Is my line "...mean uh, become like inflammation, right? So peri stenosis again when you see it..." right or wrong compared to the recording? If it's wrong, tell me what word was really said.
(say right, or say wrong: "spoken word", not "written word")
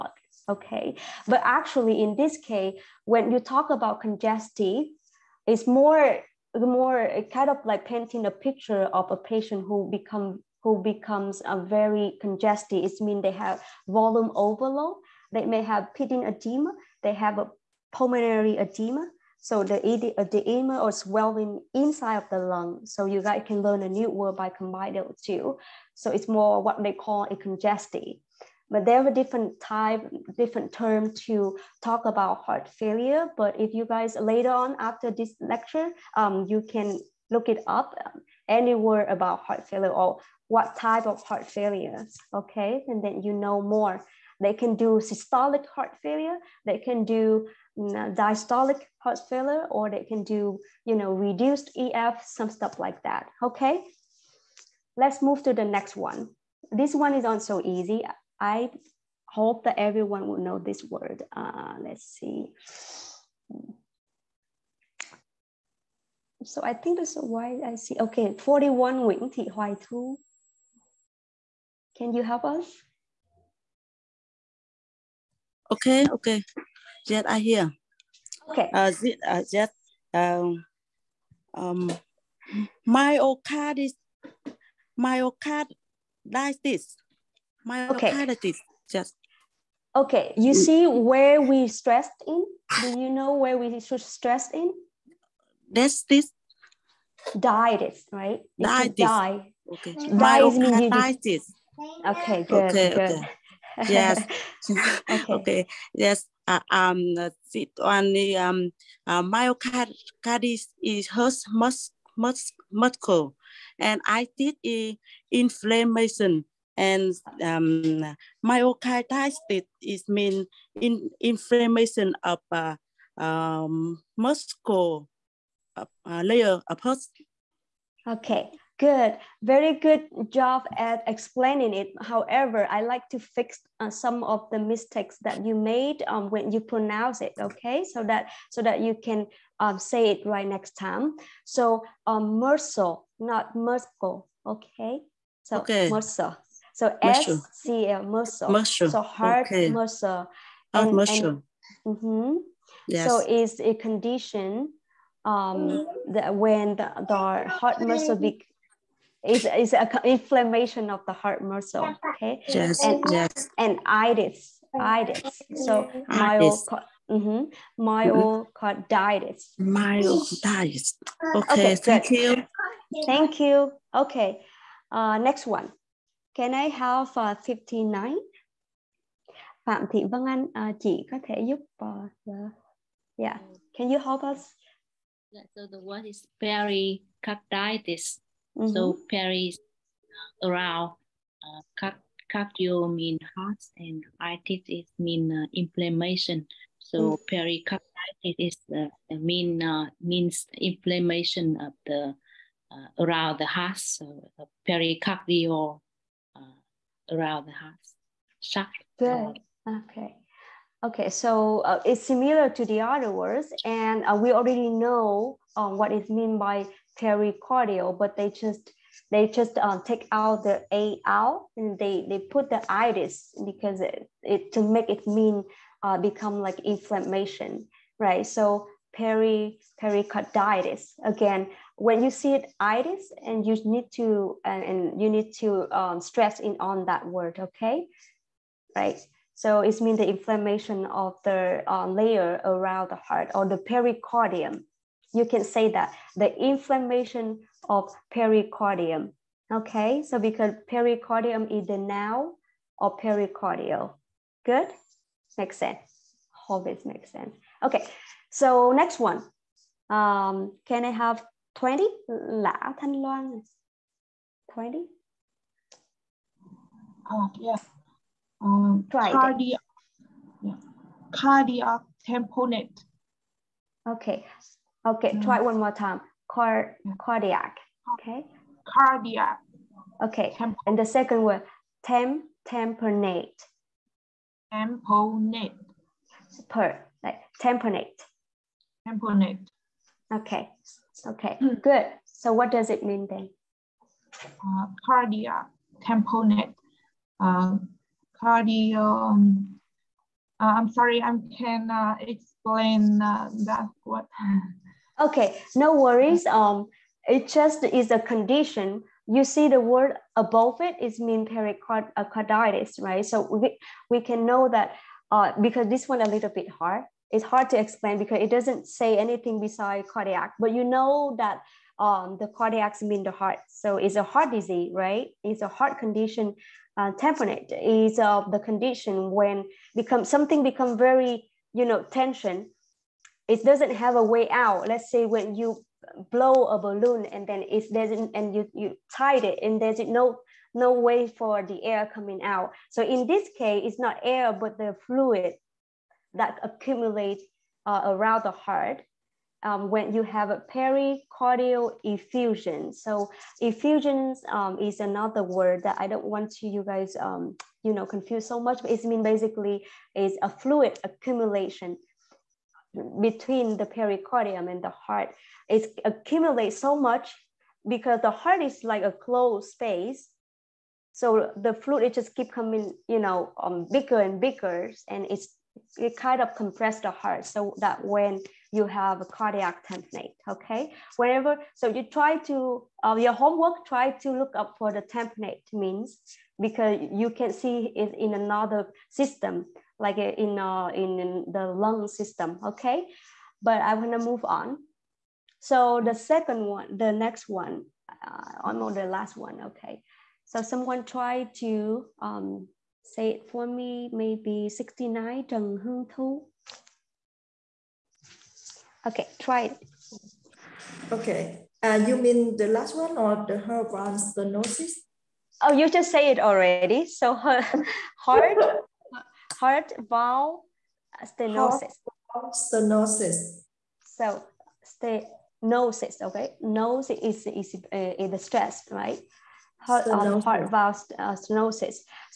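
wrong: "pericarditis", not "stenosis".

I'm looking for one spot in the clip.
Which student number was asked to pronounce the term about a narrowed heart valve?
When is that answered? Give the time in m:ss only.
6:44.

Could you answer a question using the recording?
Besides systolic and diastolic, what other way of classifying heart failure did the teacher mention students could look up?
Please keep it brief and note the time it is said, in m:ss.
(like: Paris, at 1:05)
reduced EF, at 0:51.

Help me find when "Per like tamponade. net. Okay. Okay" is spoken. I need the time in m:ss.
4:46.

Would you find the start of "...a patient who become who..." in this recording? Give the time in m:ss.
0:09.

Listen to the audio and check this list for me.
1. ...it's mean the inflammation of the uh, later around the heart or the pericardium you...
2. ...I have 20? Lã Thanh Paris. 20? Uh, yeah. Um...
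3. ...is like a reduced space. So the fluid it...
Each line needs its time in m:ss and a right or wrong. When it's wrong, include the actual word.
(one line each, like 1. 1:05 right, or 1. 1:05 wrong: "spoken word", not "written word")
1. 3:59 wrong: "layer", not "later"
2. 4:20 wrong: "Loan", not "Paris"
3. 6:08 wrong: "closed", not "reduced".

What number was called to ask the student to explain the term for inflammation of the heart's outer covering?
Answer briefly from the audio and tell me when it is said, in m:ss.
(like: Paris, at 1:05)
59, at 2:57.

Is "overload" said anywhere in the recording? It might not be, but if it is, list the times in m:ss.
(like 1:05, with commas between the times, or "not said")
0:14.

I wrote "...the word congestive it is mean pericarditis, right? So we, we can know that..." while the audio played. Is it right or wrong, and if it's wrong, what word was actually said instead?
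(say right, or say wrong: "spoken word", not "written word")
wrong: "above", not "congestive".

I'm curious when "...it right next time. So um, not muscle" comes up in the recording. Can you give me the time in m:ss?
2:20.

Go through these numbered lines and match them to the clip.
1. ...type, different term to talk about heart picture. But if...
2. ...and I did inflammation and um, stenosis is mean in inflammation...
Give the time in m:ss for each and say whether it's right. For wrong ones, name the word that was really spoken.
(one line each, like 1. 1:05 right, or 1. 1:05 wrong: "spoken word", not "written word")
1. 0:29 wrong: "failure", not "picture"
2. 1:53 wrong: "myocarditis", not "stenosis".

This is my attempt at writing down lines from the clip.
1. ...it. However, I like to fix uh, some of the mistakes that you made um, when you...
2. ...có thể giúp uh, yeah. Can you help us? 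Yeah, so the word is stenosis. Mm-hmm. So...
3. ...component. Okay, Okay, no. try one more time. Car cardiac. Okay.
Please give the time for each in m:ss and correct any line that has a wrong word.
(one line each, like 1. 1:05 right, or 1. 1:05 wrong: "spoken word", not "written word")
1. 2:11 right
2. 3:01 wrong: "pericarditis", not "stenosis"
3. 4:32 right.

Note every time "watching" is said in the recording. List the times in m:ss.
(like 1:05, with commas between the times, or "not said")
not said.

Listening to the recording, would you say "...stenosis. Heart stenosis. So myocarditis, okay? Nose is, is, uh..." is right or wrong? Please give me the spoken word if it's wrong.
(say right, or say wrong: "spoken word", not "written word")
wrong: "stenosis", not "myocarditis".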